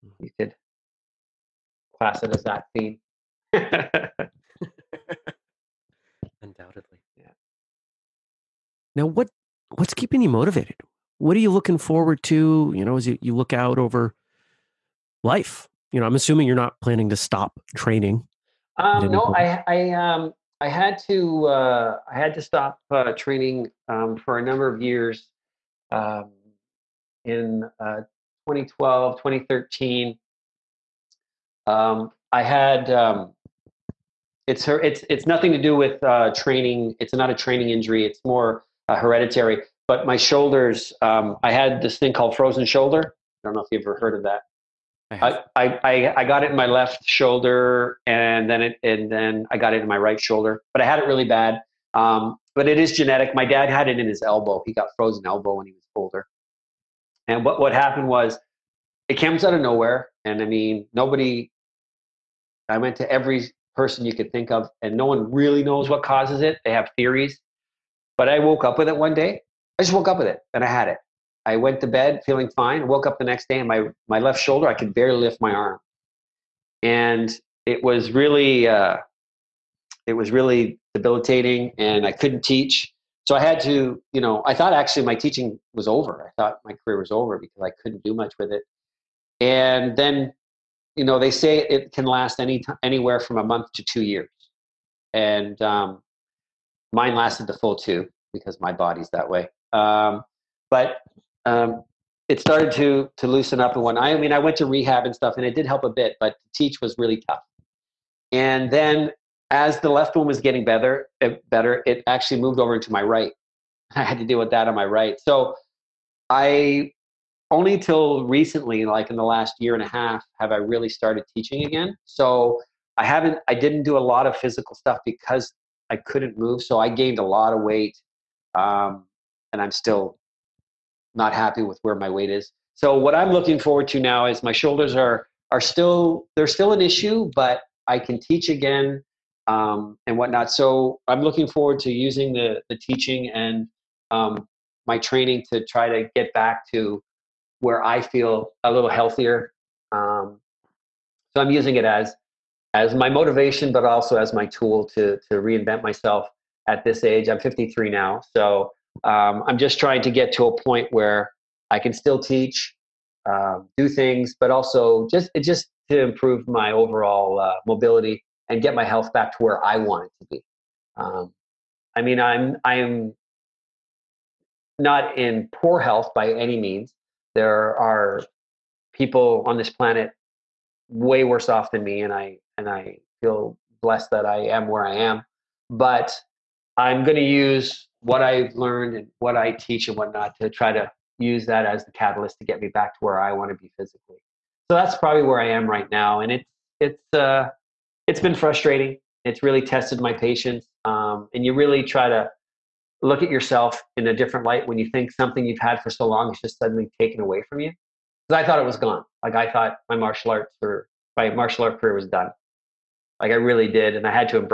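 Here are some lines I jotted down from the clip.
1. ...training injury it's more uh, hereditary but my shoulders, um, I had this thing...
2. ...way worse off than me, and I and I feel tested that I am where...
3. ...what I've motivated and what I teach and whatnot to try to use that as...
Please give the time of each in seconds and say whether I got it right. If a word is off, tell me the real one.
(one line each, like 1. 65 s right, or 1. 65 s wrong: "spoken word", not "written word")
1. 37 s right
2. 180 s wrong: "blessed", not "tested"
3. 188 s wrong: "learned", not "motivated".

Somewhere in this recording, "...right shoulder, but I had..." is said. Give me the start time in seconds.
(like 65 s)
49 s.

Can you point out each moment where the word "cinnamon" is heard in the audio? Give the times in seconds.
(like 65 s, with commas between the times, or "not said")
not said.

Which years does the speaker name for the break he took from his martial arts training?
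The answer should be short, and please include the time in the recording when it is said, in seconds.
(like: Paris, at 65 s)
2012-2013, at 28 s.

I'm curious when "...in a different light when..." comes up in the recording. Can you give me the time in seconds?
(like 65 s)
203 s.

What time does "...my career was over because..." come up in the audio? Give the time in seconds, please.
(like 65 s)
86 s.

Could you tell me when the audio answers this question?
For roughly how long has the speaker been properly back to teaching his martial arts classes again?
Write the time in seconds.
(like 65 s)
119 s.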